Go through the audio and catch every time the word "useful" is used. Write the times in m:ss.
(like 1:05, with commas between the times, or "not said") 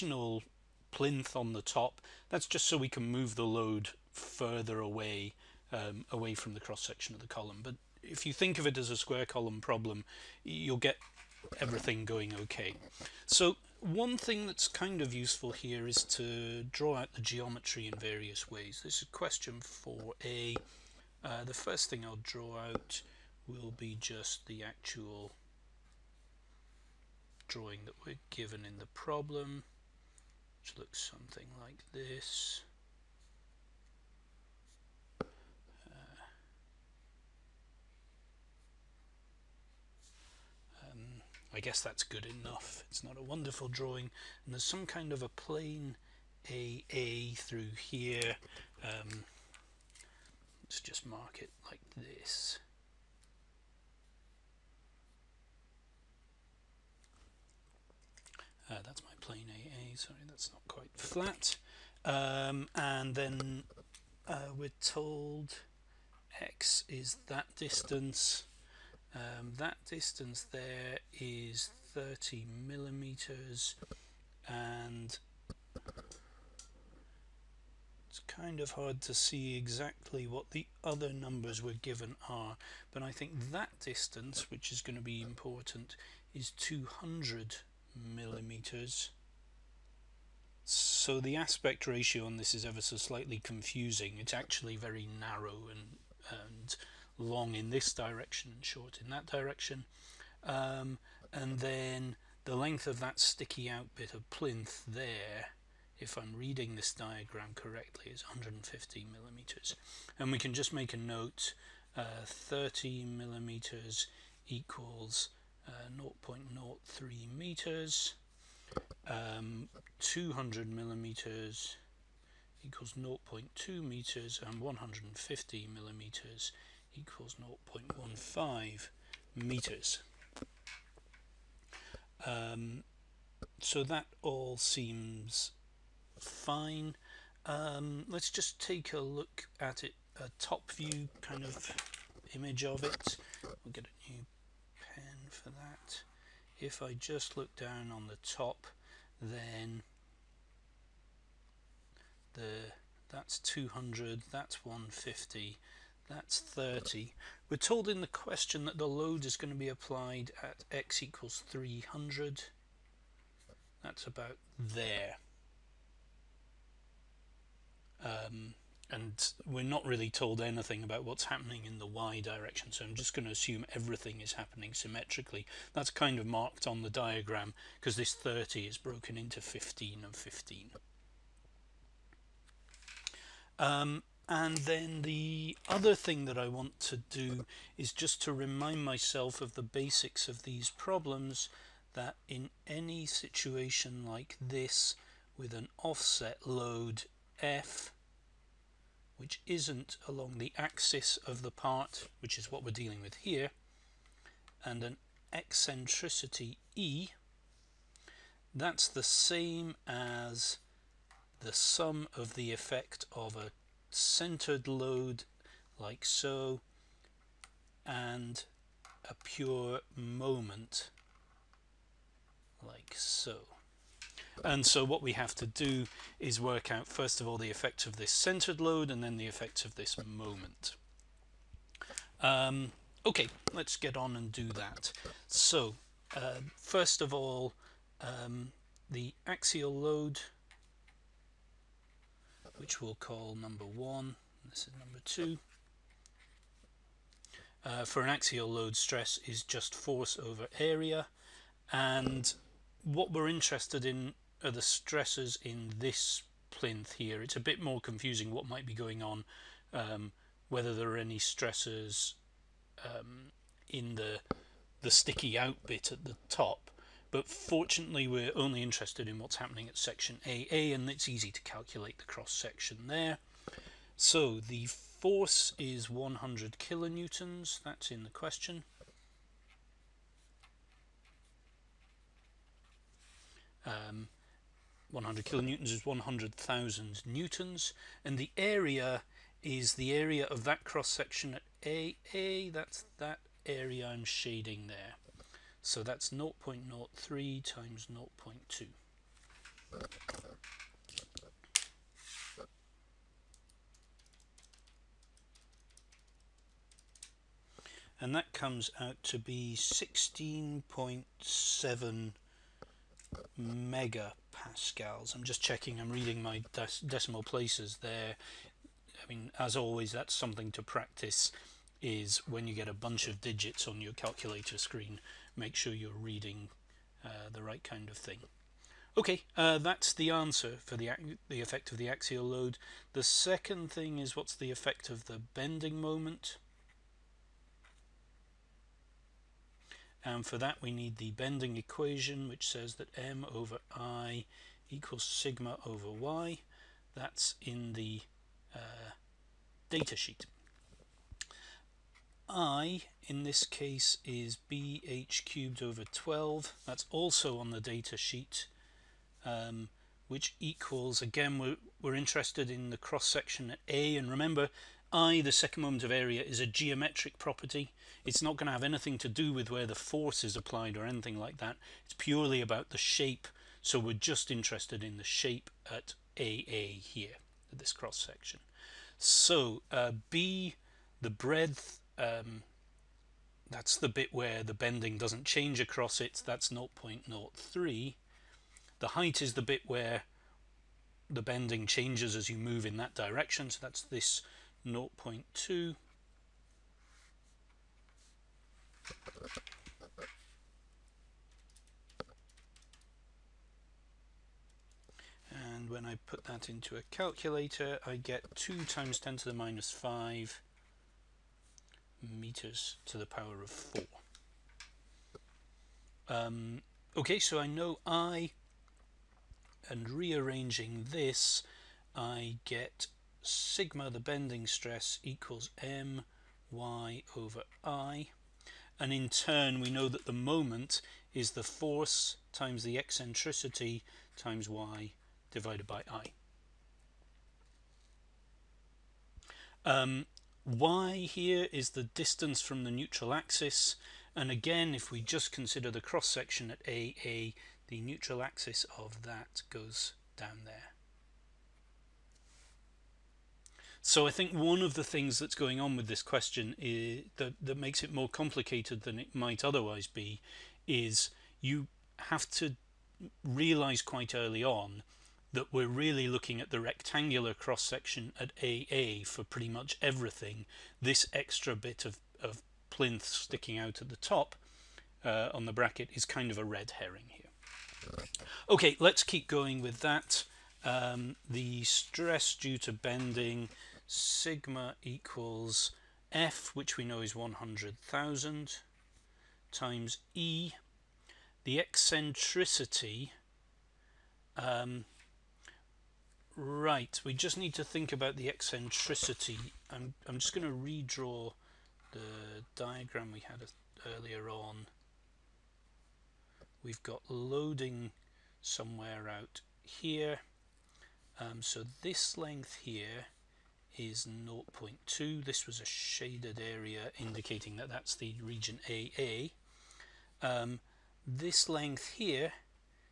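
0:15.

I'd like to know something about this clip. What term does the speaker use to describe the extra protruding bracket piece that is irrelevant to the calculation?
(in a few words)
red herring.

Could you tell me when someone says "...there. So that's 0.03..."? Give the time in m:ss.
4:54.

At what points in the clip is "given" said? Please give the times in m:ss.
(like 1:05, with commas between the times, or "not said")
0:28, 1:21.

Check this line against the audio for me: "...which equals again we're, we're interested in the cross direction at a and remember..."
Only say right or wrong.
wrong.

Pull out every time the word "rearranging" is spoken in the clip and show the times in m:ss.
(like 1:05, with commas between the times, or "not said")
6:59.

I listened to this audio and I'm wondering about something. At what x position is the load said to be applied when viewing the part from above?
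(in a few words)
300.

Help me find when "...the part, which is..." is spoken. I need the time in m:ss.
3:21.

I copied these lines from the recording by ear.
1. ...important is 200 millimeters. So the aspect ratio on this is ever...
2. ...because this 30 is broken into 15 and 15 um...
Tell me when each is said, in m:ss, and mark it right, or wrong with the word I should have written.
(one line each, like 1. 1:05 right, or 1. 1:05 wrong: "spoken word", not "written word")
1. 1:25 right
2. 2:57 right.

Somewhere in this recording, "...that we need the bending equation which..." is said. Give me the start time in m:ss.
5:40.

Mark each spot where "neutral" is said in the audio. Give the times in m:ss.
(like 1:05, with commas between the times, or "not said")
7:22, 7:27.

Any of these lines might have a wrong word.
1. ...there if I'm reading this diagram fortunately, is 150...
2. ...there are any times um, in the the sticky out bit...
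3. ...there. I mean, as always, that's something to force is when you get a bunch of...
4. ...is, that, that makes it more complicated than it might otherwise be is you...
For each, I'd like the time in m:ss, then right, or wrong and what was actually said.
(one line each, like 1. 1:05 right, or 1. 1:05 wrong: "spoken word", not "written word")
1. 1:44 wrong: "correctly", not "fortunately"
2. 4:20 wrong: "stresses", not "times"
3. 5:17 wrong: "practice", not "force"
4. 7:36 right.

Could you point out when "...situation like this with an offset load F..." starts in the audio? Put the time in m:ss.
3:13.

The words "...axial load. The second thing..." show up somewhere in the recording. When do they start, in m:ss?
5:31.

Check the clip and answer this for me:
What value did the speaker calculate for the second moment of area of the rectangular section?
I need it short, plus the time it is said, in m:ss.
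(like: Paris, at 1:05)
2 x 10^-5 m^4, at 6:48.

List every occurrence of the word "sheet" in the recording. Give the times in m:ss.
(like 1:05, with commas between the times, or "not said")
5:49, 5:57.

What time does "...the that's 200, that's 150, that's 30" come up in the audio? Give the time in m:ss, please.
2:32.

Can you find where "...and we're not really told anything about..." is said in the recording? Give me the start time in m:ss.
2:48.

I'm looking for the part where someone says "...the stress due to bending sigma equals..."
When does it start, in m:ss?
8:01.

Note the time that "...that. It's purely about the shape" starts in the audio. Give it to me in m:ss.
6:11.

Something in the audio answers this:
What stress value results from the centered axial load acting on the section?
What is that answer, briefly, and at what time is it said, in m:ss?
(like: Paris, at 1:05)
16.7 MPa, at 5:09.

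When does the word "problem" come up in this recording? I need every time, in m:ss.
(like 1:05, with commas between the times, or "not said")
0:09, 0:28, 3:10.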